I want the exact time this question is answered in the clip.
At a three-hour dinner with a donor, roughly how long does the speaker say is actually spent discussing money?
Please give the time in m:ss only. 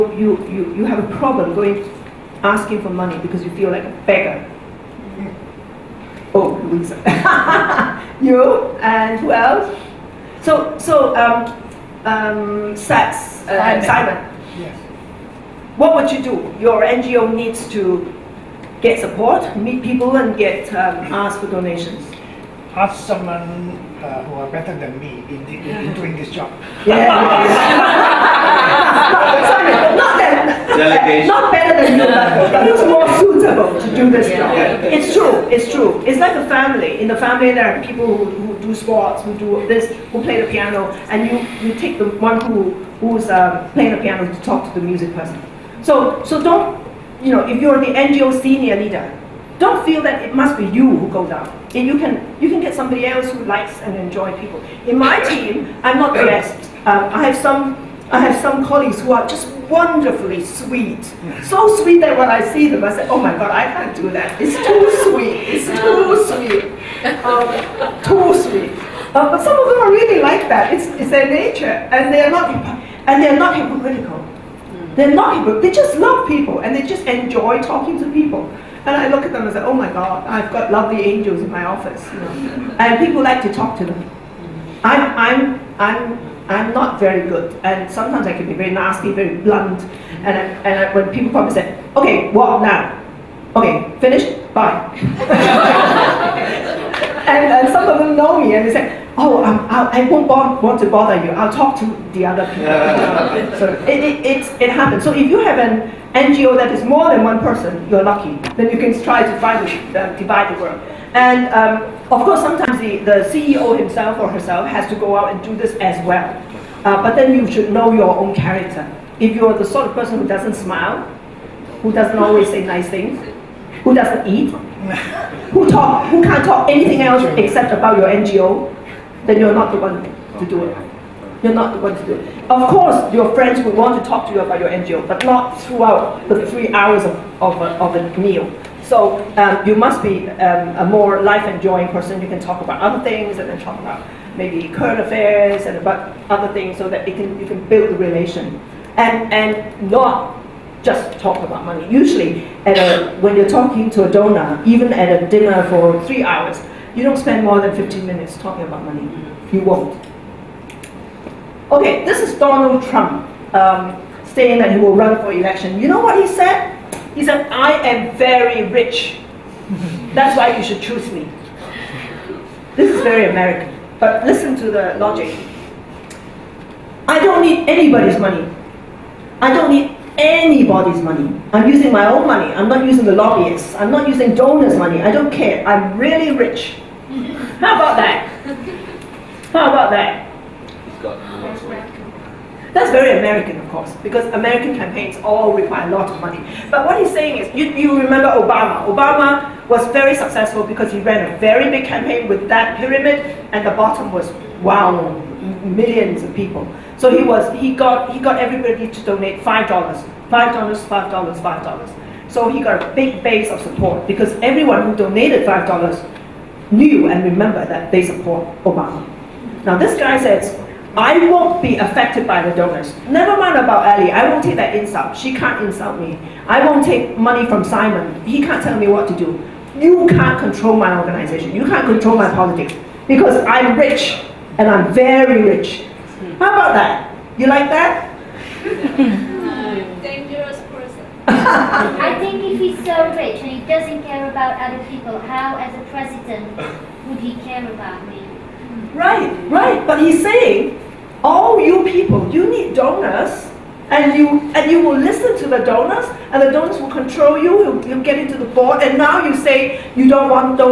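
2:37.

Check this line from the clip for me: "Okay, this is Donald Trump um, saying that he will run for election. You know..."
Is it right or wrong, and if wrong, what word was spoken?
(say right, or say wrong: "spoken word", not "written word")
right.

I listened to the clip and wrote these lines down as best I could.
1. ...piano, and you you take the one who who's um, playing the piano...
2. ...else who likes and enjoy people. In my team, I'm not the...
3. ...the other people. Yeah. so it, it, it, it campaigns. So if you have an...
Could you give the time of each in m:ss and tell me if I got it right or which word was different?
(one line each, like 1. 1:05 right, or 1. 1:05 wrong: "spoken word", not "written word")
1. 0:40 right
2. 0:53 right
3. 1:42 wrong: "happens", not "campaigns".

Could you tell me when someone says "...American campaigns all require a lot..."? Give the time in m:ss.
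3:14.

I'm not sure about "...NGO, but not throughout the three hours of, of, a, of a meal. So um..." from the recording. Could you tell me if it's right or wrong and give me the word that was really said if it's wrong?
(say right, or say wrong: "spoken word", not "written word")
right.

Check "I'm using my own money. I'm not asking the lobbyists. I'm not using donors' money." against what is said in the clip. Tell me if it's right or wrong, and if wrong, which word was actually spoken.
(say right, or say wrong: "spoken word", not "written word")
wrong: "using", not "asking".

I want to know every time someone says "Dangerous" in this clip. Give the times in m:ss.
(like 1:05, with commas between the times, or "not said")
4:00.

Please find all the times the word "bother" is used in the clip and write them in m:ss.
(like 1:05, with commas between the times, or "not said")
1:40.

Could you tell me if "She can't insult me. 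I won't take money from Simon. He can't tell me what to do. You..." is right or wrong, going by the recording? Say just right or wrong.
right.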